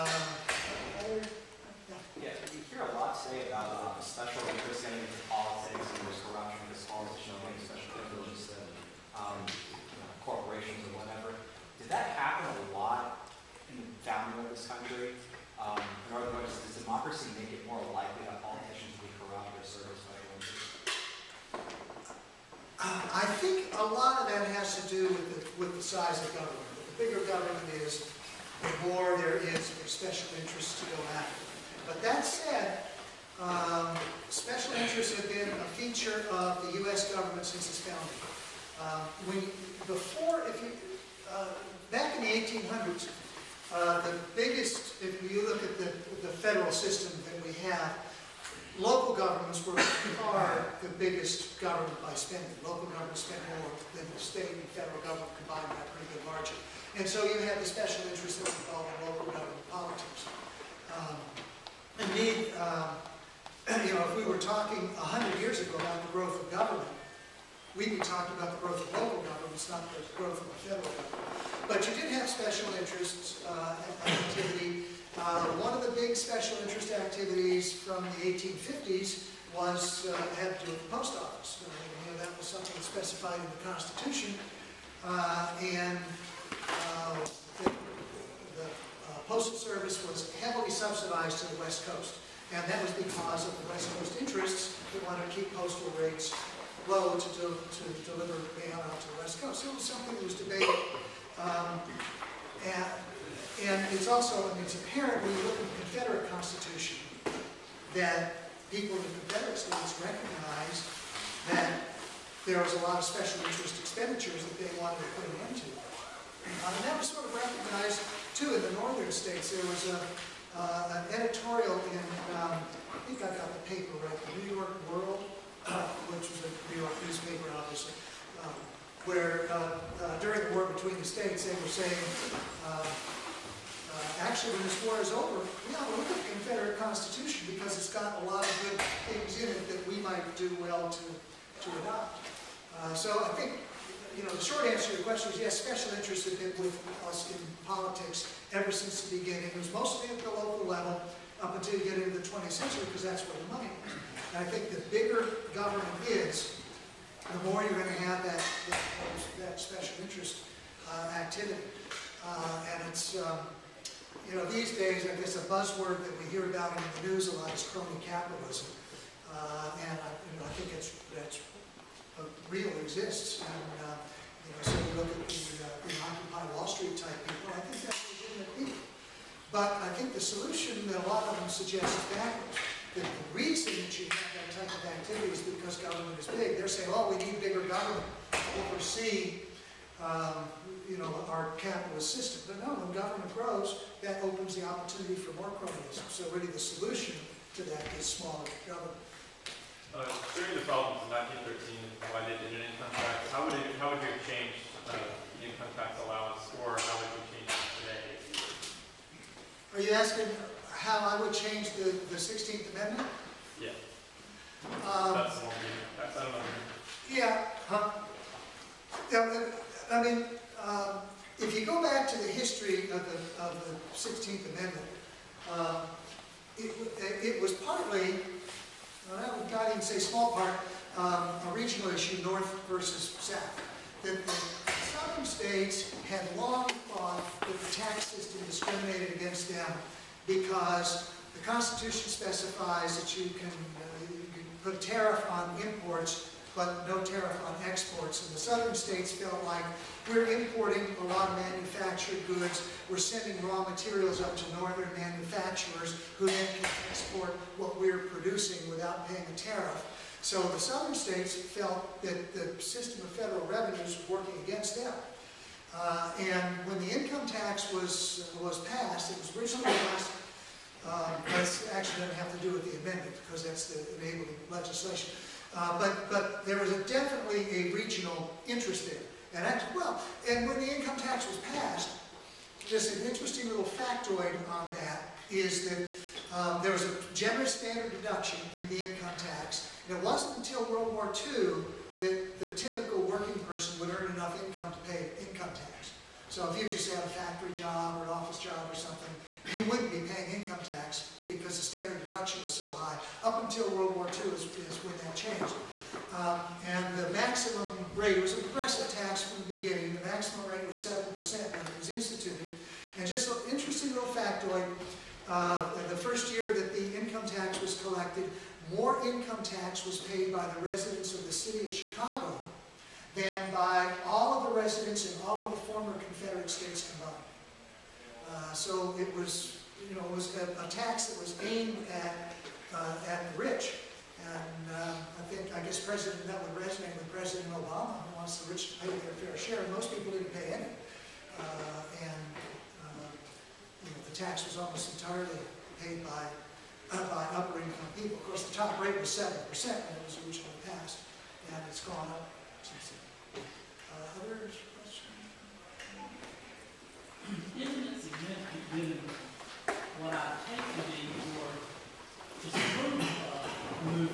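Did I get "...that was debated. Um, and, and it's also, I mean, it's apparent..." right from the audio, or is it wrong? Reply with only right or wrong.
right.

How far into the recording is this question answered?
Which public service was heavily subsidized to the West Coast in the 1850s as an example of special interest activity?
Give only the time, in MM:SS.
01:29.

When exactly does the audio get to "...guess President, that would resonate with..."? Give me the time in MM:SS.
05:35.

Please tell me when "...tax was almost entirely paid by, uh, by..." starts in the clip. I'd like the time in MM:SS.
05:44.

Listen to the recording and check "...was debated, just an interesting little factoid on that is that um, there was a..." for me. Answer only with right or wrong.
wrong.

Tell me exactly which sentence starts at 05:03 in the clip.
Up until World War II is, is when that changed.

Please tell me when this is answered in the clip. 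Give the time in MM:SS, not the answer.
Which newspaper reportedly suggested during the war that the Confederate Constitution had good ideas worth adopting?
02:04.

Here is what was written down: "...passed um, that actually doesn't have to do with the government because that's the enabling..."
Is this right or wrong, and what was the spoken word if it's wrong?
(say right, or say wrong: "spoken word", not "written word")
wrong: "amendment", not "government".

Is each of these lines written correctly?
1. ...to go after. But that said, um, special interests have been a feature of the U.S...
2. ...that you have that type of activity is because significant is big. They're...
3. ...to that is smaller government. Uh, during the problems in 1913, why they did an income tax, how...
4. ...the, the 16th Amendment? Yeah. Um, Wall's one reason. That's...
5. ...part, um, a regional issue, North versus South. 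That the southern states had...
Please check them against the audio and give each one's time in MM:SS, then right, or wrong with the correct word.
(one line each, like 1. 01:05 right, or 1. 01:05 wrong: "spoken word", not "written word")
1. 00:30 right
2. 03:03 wrong: "government", not "significant"
3. 03:17 right
4. 03:31 wrong: "That", not "Wall"
5. 03:50 right.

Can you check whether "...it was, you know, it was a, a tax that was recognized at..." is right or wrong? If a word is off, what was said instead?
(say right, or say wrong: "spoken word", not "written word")
wrong: "aimed", not "recognized".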